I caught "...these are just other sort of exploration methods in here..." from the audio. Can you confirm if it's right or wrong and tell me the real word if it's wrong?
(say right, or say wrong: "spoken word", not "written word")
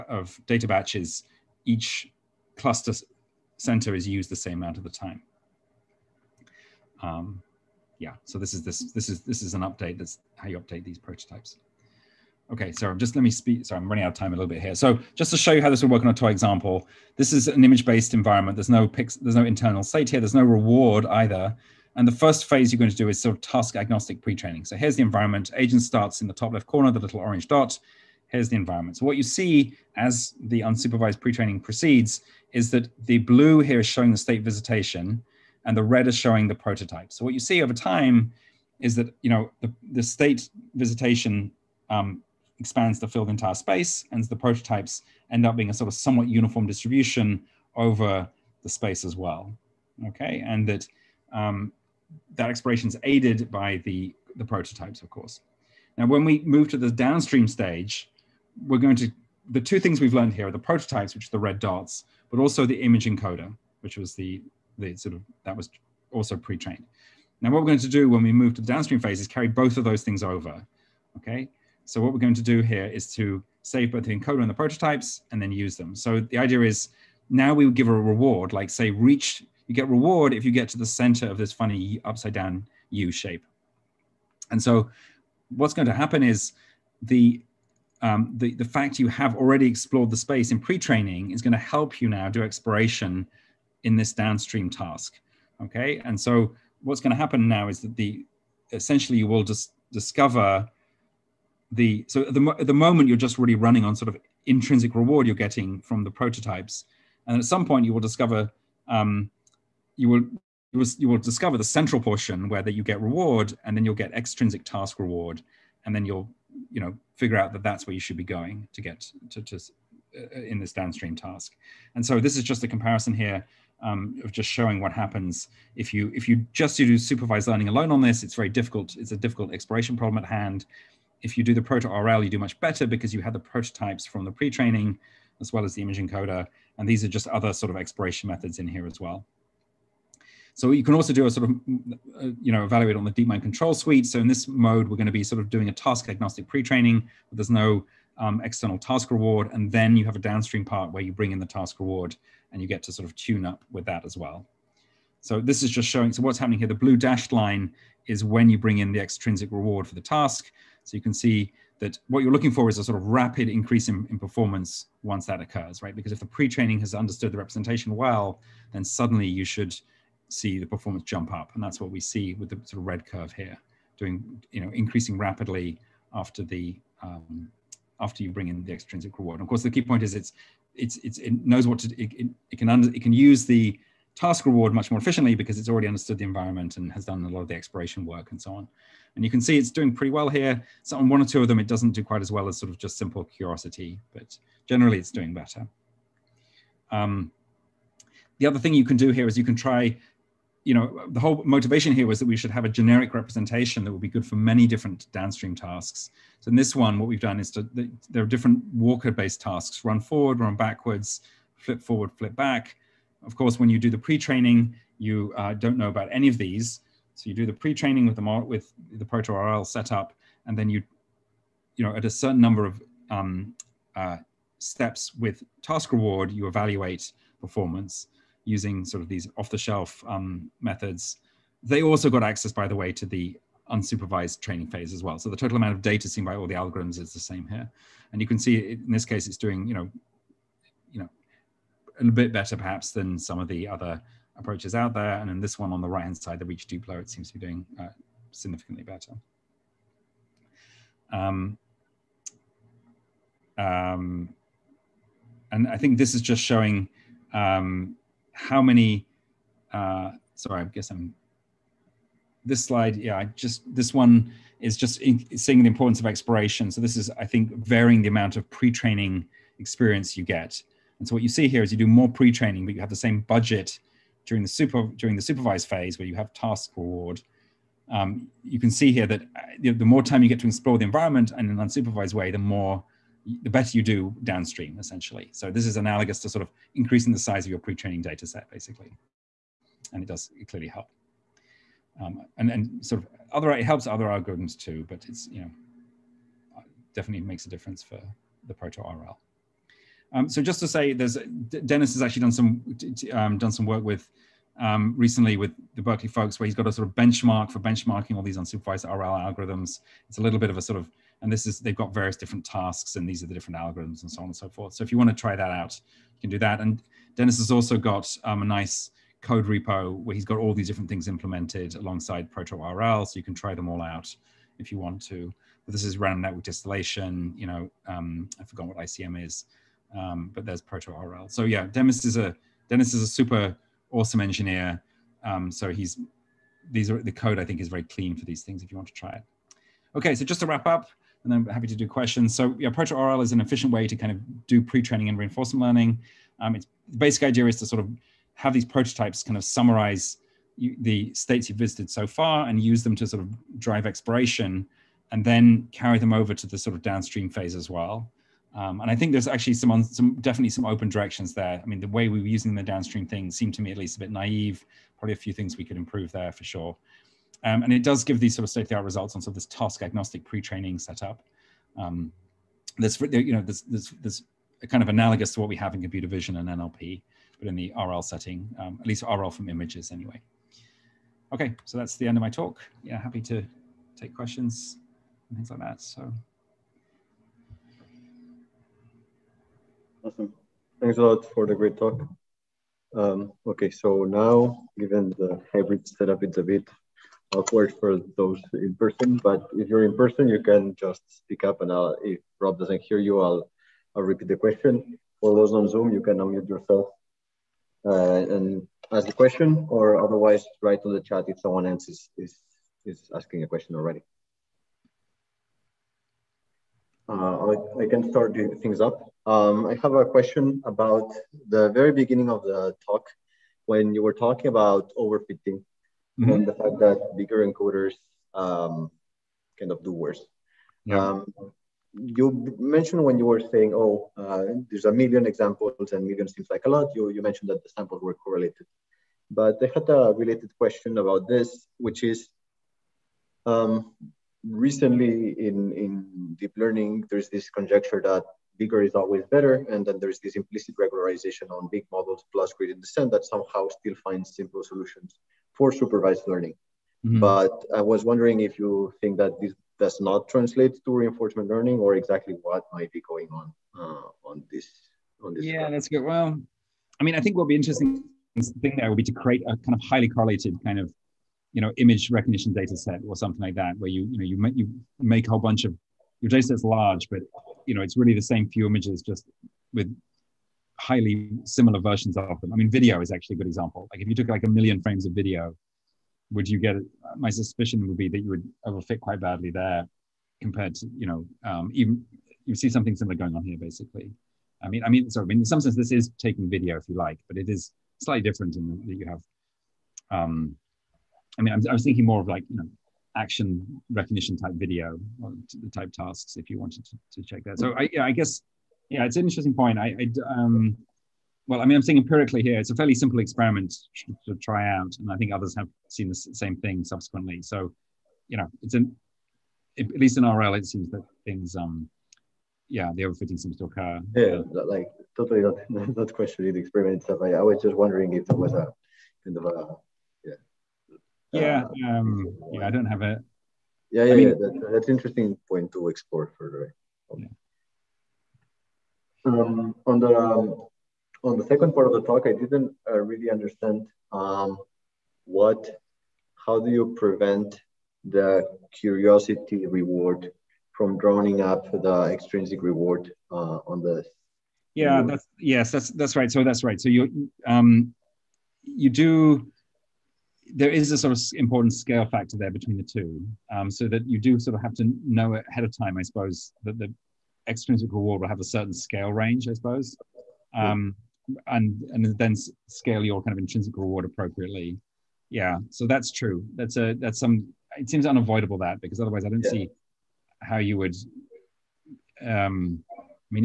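right.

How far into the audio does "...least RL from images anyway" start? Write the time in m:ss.
6:18.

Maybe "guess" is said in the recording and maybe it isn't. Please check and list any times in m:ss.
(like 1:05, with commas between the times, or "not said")
4:20, 8:28.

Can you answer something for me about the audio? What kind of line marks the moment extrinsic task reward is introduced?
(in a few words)
blue dashed line.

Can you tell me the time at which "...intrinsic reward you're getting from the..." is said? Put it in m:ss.
1:44.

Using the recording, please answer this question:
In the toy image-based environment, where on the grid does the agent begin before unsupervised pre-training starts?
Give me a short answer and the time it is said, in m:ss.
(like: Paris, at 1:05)
top left corner, at 0:26.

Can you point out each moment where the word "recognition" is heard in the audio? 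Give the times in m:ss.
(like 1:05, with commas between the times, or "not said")
7:52, 8:23.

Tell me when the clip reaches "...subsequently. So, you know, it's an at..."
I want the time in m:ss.
8:36.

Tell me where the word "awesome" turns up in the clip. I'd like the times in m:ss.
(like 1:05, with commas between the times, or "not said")
5:33, 6:30.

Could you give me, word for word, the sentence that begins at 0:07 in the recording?
Um, yeah, so this is this this is this is an update.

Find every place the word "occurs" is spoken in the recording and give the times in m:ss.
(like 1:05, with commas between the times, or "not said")
2:45, 8:43.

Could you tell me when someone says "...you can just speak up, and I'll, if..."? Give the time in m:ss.
6:40.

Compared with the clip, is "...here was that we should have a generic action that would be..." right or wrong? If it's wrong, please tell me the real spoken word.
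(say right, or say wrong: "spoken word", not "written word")
wrong: "representation", not "action".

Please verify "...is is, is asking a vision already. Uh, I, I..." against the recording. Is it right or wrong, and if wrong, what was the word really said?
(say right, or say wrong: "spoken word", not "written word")
wrong: "question", not "vision".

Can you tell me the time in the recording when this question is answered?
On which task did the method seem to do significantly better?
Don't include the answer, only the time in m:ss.
4:06.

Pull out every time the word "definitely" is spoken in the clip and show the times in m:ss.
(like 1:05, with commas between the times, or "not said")
4:56, 6:00.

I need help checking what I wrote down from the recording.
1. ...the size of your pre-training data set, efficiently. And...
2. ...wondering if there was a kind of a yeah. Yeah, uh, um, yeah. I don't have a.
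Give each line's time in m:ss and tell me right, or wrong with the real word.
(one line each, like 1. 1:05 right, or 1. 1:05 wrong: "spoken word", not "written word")
1. 4:47 wrong: "basically", not "efficiently"
2. 8:47 right.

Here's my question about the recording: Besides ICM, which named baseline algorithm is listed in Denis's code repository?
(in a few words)
random network distillation.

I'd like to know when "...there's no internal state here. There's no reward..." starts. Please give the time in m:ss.
0:19.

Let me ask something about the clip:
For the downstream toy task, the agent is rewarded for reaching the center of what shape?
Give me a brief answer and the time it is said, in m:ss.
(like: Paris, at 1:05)
upside down U, at 1:21.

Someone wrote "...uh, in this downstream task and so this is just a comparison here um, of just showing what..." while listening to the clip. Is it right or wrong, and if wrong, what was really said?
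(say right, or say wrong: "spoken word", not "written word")
right.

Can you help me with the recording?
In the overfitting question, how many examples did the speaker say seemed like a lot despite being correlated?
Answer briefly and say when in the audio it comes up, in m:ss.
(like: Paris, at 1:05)
1 million, at 7:14.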